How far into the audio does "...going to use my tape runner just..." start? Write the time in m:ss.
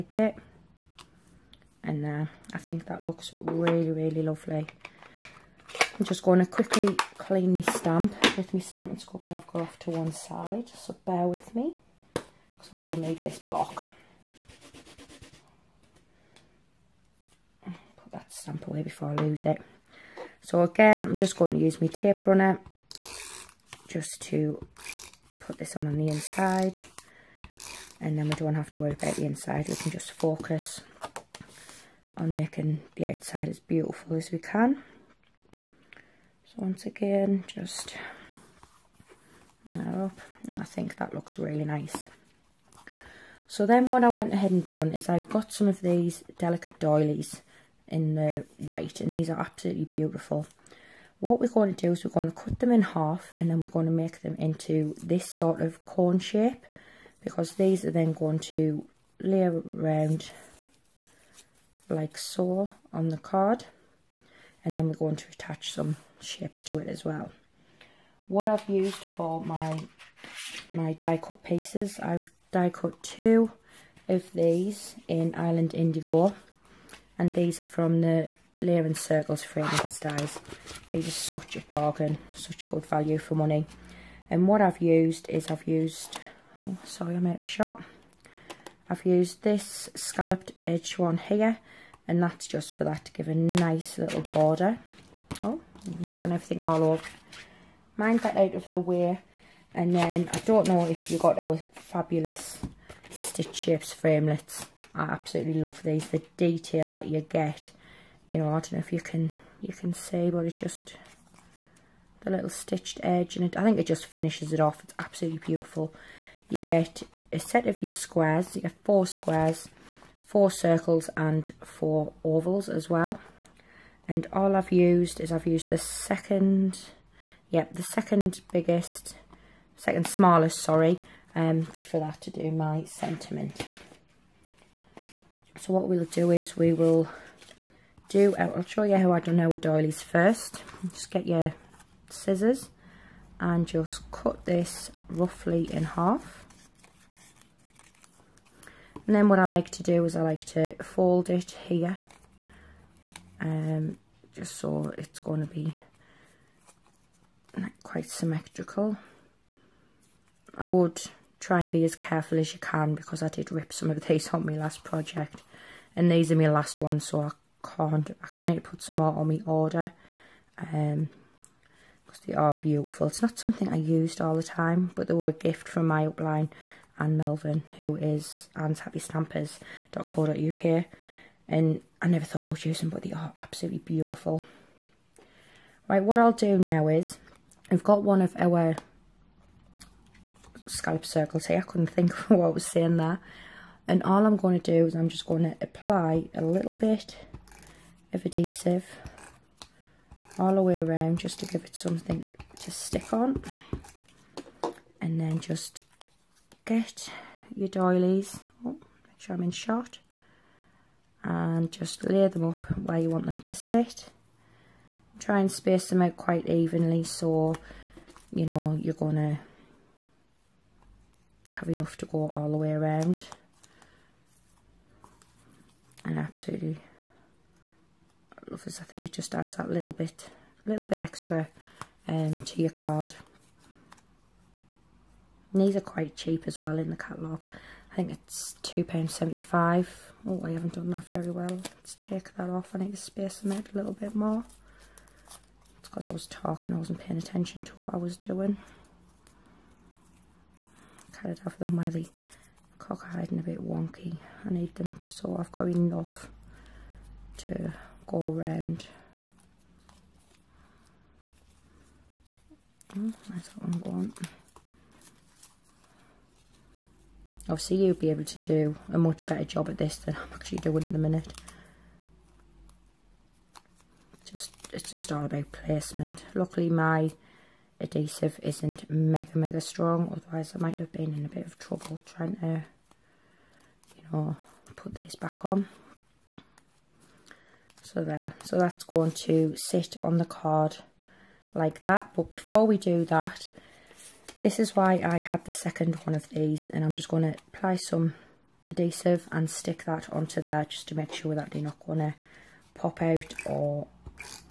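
0:21.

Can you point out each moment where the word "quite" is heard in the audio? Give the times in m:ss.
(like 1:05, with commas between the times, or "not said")
2:37, 3:36, 3:55.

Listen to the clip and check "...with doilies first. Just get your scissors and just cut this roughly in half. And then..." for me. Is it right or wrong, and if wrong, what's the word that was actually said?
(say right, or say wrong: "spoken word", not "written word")
right.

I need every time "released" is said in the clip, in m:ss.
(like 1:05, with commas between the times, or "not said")
not said.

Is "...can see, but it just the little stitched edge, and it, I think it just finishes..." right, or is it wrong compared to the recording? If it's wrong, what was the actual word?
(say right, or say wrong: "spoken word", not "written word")
right.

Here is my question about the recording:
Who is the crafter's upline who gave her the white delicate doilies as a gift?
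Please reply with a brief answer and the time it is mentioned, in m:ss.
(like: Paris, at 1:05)
Anne Melvin, at 2:56.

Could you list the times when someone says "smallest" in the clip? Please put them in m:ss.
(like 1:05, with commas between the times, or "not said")
2:10.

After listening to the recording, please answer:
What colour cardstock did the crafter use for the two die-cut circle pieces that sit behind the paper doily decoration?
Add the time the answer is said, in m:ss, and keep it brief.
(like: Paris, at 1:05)
Island Indigo, at 1:15.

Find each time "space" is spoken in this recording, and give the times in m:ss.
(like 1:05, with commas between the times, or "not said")
3:35, 4:02.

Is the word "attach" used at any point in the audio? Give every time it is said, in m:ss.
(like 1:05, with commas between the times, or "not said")
1:05.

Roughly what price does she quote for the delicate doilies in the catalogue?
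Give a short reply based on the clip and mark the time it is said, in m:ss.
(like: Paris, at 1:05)
£2.75, at 3:58.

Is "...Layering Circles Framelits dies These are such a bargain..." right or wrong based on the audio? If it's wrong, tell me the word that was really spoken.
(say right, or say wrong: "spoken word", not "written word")
right.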